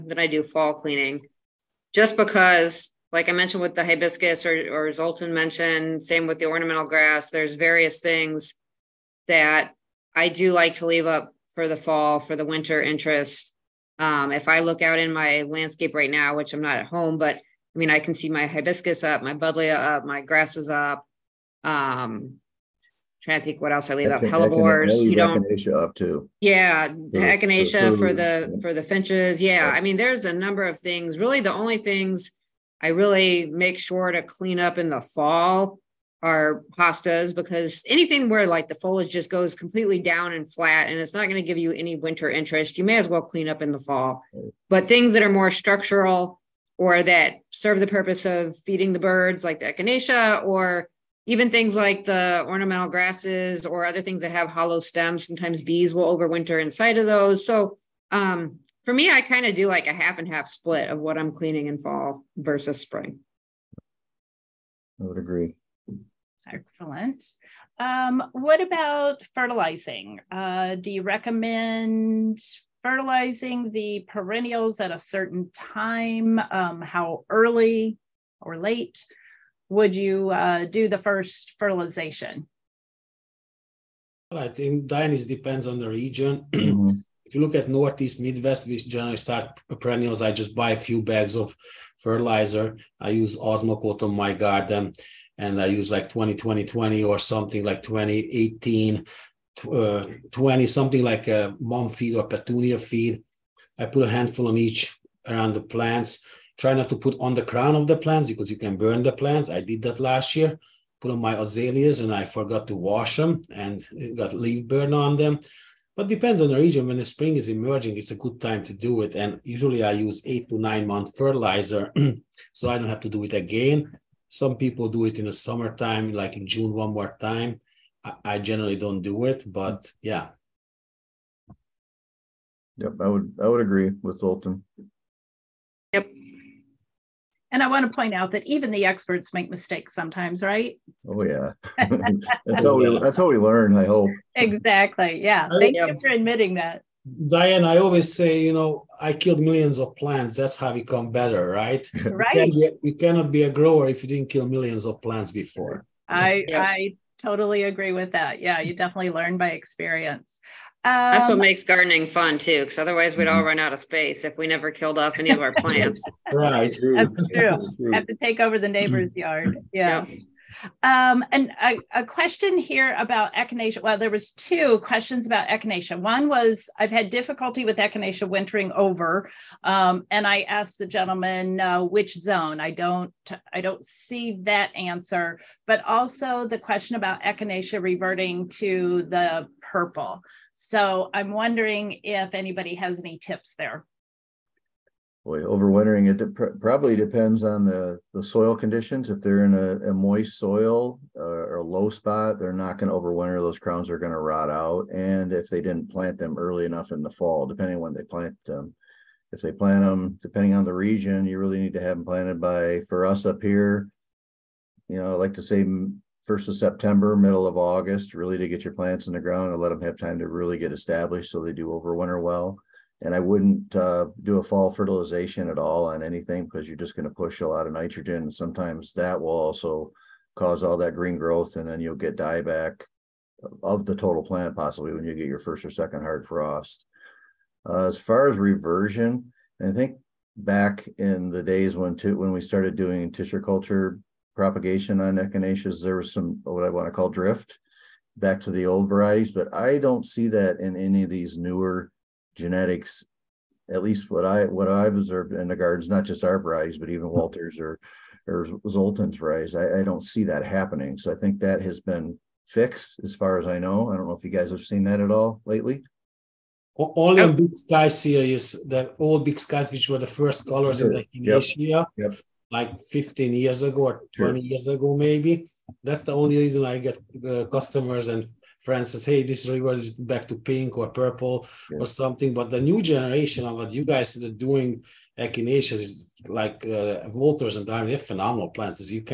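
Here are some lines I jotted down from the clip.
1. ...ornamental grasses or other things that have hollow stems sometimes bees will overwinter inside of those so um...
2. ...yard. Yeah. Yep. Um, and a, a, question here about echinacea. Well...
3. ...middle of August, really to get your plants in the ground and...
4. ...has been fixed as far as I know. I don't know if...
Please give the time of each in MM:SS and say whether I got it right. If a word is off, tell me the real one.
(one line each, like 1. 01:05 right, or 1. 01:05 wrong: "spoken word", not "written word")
1. 00:52 right
2. 02:49 right
3. 03:37 right
4. 04:21 right.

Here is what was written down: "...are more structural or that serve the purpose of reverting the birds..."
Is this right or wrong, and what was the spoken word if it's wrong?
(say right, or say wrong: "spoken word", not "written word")
wrong: "feeding", not "reverting".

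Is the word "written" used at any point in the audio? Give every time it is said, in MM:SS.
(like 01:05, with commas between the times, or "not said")
not said.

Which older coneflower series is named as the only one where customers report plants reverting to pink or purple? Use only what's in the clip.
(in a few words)
Big Sky.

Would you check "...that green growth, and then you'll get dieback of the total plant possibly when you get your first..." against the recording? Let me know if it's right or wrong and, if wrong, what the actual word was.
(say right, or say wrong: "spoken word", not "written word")
right.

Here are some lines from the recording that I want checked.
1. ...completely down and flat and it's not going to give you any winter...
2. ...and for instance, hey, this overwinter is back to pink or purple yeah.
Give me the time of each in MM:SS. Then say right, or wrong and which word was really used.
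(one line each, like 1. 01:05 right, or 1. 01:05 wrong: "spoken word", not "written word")
1. 00:39 right
2. 04:38 wrong: "river", not "overwinter".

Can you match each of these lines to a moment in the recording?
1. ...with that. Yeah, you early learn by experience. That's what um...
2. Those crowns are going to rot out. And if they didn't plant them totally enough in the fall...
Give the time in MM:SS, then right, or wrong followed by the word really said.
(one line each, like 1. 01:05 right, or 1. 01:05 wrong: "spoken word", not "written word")
1. 02:37 wrong: "definitely", not "early"
2. 03:23 wrong: "early", not "totally".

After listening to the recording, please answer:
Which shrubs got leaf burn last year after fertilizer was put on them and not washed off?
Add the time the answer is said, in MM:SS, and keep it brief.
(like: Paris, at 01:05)
Azaleas, at 01:51.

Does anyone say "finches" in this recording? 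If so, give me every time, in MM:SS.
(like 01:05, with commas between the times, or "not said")
00:28.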